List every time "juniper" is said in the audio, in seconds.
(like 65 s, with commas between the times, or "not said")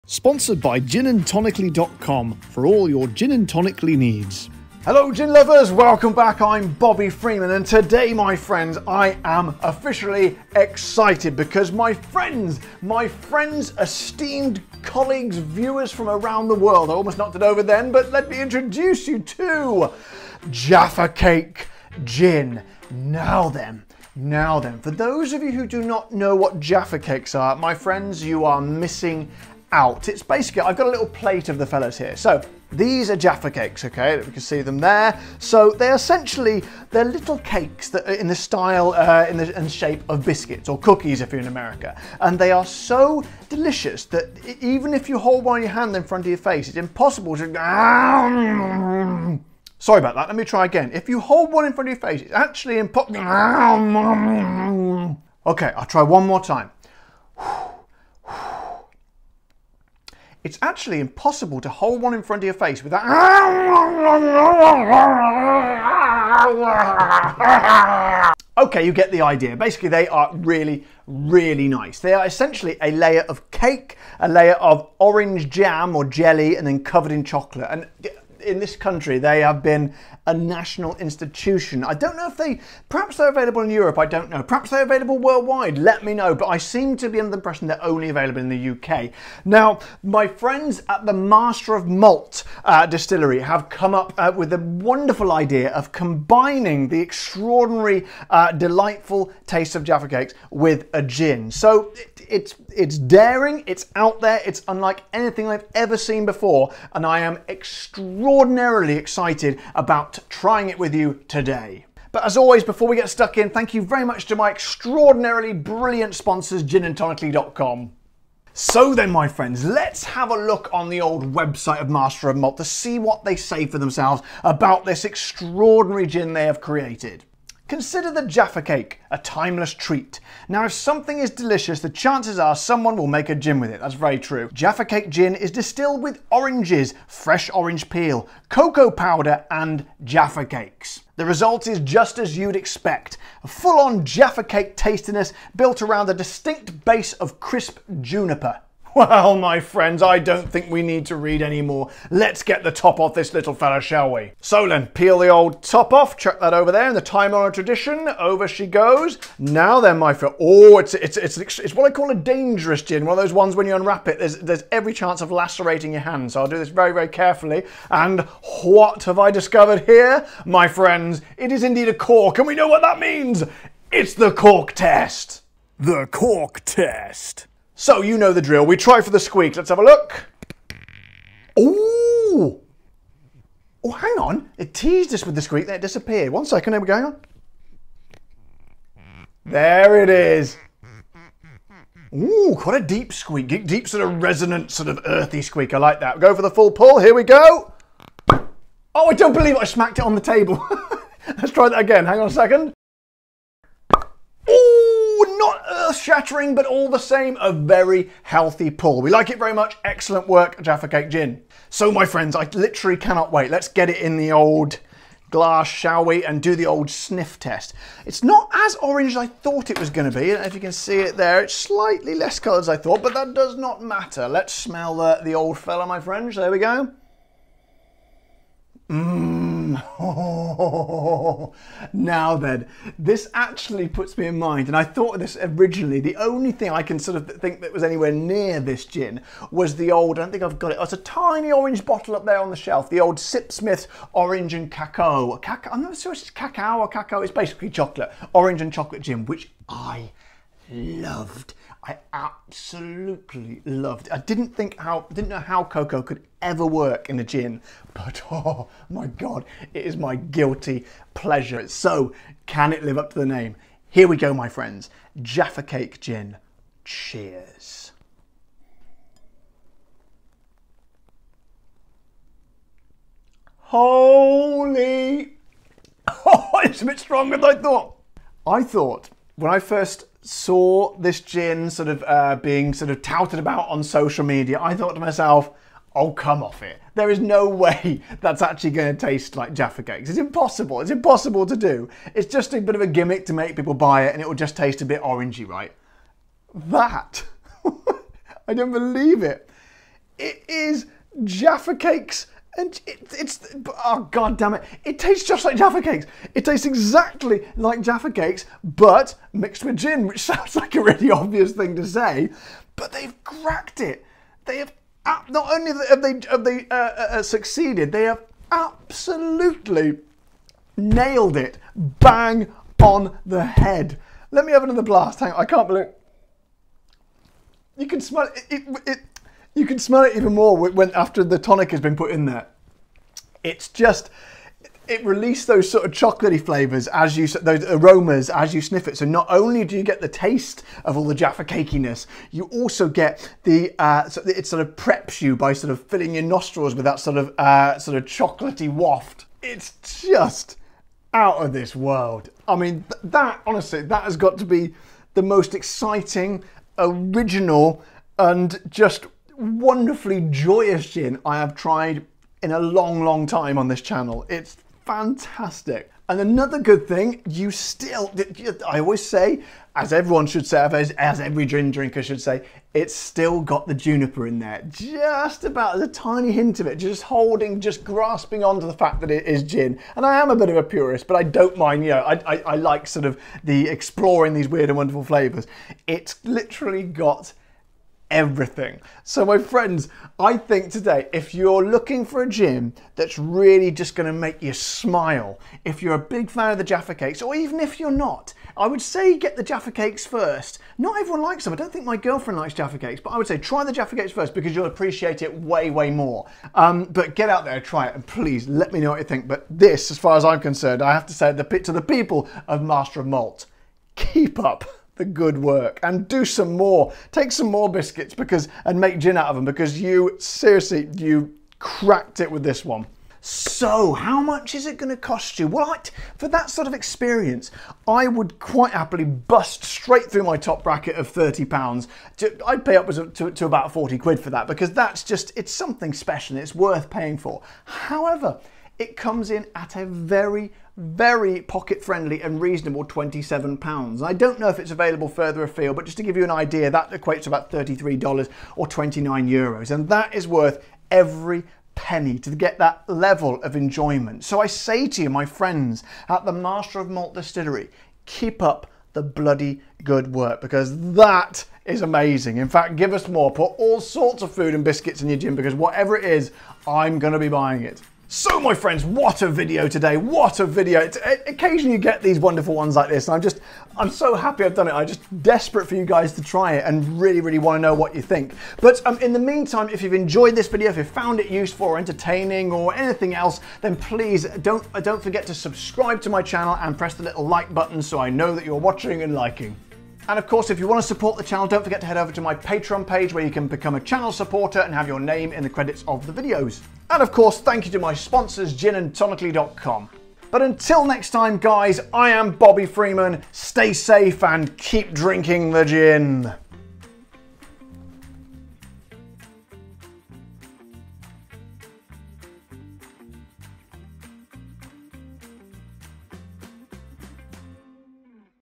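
148 s, 373 s.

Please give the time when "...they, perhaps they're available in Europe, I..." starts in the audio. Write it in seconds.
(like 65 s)
82 s.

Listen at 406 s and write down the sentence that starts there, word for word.
Um, but get out there, try it, and please let me know what you think.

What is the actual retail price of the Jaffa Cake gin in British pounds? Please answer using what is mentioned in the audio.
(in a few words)
£27.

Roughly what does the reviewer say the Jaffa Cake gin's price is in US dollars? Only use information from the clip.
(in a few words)
$33.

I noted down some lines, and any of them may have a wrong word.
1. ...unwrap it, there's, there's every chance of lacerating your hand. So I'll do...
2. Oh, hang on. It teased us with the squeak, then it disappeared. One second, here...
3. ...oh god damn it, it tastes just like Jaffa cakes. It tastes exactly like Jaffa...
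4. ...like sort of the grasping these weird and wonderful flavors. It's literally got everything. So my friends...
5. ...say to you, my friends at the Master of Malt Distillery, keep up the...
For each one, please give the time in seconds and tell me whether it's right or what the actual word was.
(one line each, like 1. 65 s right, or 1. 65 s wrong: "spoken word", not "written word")
1. 163 s right
2. 183 s right
3. 303 s right
4. 382 s wrong: "exploring", not "grasping"
5. 454 s right.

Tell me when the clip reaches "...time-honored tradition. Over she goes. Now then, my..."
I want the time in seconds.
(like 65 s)
157 s.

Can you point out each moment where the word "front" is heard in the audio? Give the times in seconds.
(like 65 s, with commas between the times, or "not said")
46 s, 51 s, 62 s.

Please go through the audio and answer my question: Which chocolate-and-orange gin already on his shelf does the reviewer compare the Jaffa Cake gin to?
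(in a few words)
Sip Orange and Cacao.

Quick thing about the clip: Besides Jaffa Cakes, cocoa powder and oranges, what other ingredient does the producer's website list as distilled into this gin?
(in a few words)
fresh orange peel.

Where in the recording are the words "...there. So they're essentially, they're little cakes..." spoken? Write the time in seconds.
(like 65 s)
34 s.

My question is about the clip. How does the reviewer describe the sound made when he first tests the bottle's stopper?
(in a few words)
deep squeak.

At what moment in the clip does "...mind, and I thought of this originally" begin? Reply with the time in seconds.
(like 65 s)
234 s.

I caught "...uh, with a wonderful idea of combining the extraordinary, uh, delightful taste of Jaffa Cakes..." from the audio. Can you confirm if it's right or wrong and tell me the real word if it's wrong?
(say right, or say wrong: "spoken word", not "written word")
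right.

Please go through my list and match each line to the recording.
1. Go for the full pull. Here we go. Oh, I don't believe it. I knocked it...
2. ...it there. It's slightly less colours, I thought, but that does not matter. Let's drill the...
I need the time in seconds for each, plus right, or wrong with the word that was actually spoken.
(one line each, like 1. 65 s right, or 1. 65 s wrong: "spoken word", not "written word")
1. 196 s wrong: "smacked", not "knocked"
2. 220 s wrong: "smell", not "drill".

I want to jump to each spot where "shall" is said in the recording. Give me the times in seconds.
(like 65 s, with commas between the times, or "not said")
153 s, 215 s.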